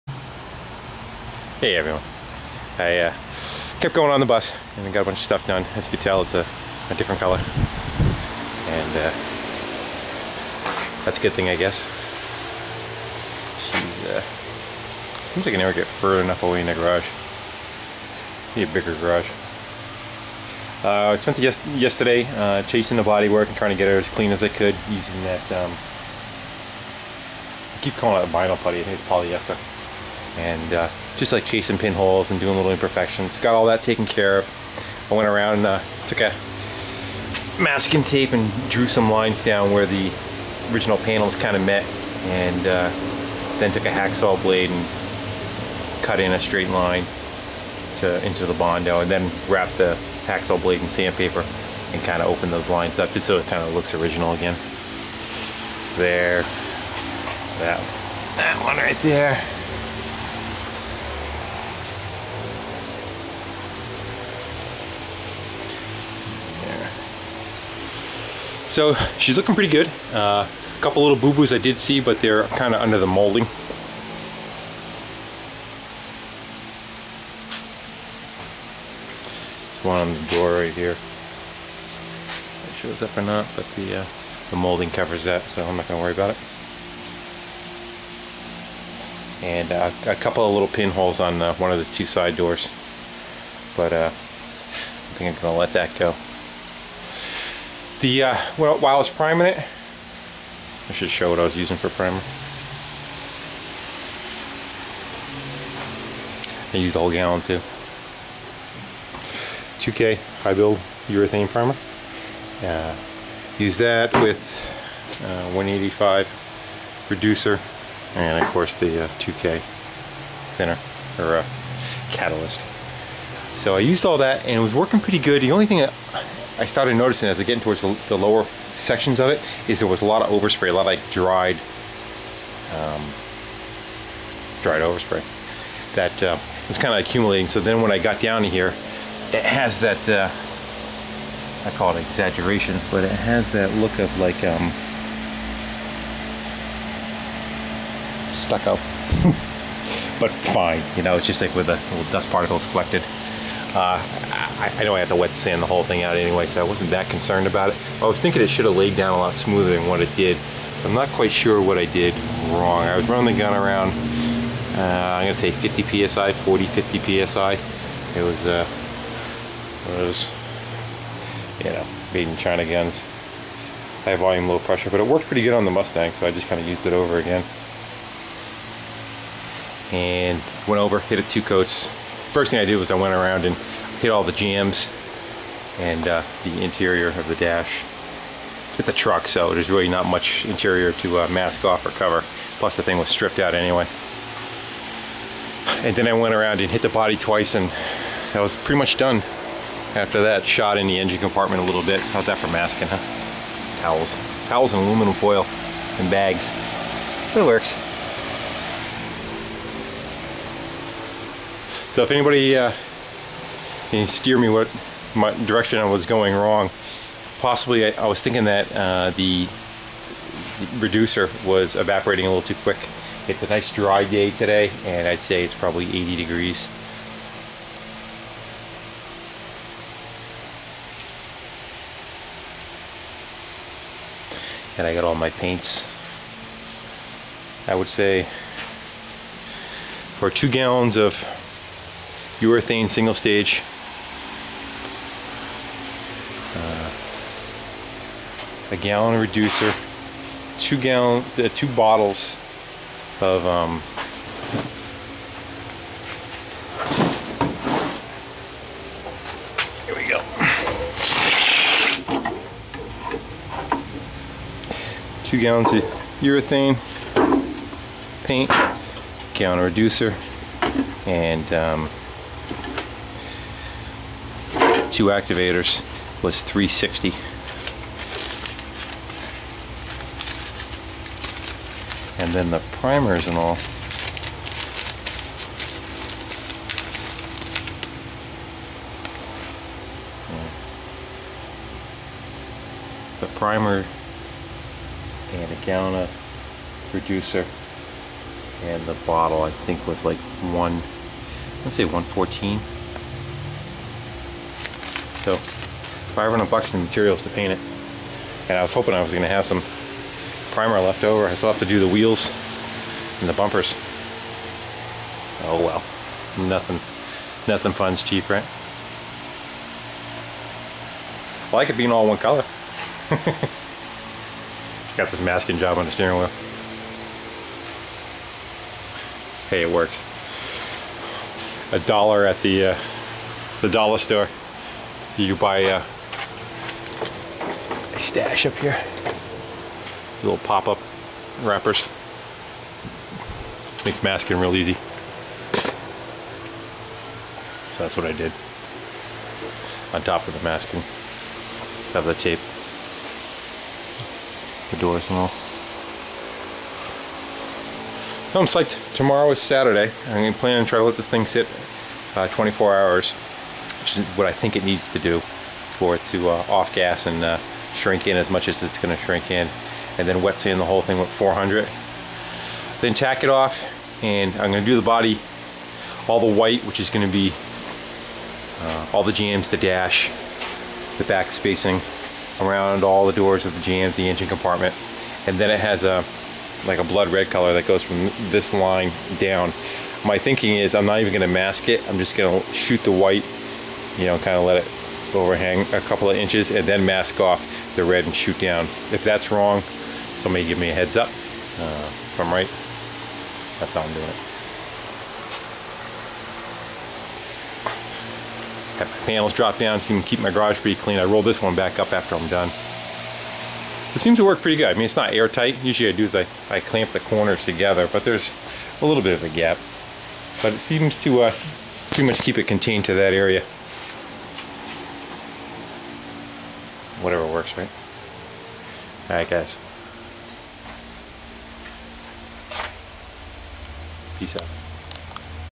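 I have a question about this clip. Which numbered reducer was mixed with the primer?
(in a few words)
185.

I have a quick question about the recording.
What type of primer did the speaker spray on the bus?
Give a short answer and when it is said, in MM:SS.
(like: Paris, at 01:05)
2K high build urethane primer, at 01:49.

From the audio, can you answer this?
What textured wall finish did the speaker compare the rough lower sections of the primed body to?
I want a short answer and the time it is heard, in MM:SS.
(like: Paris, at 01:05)
Stucco, at 02:28.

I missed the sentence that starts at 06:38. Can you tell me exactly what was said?
If that's wrong, somebody give me a heads up.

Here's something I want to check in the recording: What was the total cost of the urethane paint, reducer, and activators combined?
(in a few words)
$360.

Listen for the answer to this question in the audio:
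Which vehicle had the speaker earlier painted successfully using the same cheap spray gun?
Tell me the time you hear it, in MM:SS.
02:55.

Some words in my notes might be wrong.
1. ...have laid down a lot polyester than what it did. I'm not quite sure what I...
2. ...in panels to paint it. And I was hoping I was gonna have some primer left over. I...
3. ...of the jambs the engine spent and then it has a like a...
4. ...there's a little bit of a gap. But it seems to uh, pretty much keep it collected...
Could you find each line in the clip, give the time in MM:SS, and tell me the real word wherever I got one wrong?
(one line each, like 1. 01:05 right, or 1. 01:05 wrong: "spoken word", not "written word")
1. 02:38 wrong: "smoother", not "polyester"
2. 05:06 wrong: "materials", not "panels"
3. 06:23 wrong: "compartment", not "spent"
4. 06:58 wrong: "contained", not "collected".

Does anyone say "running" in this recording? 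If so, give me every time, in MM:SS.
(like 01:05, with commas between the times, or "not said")
02:43.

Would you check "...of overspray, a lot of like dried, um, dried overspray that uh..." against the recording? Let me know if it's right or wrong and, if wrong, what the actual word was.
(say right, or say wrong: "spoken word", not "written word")
right.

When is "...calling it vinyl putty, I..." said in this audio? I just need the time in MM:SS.
00:27.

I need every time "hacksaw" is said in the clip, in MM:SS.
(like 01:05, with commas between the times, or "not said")
00:43, 00:50.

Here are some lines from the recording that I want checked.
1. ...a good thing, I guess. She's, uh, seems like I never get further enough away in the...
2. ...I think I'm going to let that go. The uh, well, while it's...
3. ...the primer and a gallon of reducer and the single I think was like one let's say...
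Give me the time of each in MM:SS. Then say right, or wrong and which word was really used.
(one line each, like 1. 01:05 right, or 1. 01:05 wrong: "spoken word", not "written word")
1. 00:11 right
2. 01:34 right
3. 04:53 wrong: "bottle", not "single".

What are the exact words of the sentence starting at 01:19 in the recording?
one on the door right here.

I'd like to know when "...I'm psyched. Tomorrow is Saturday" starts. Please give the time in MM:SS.
05:58.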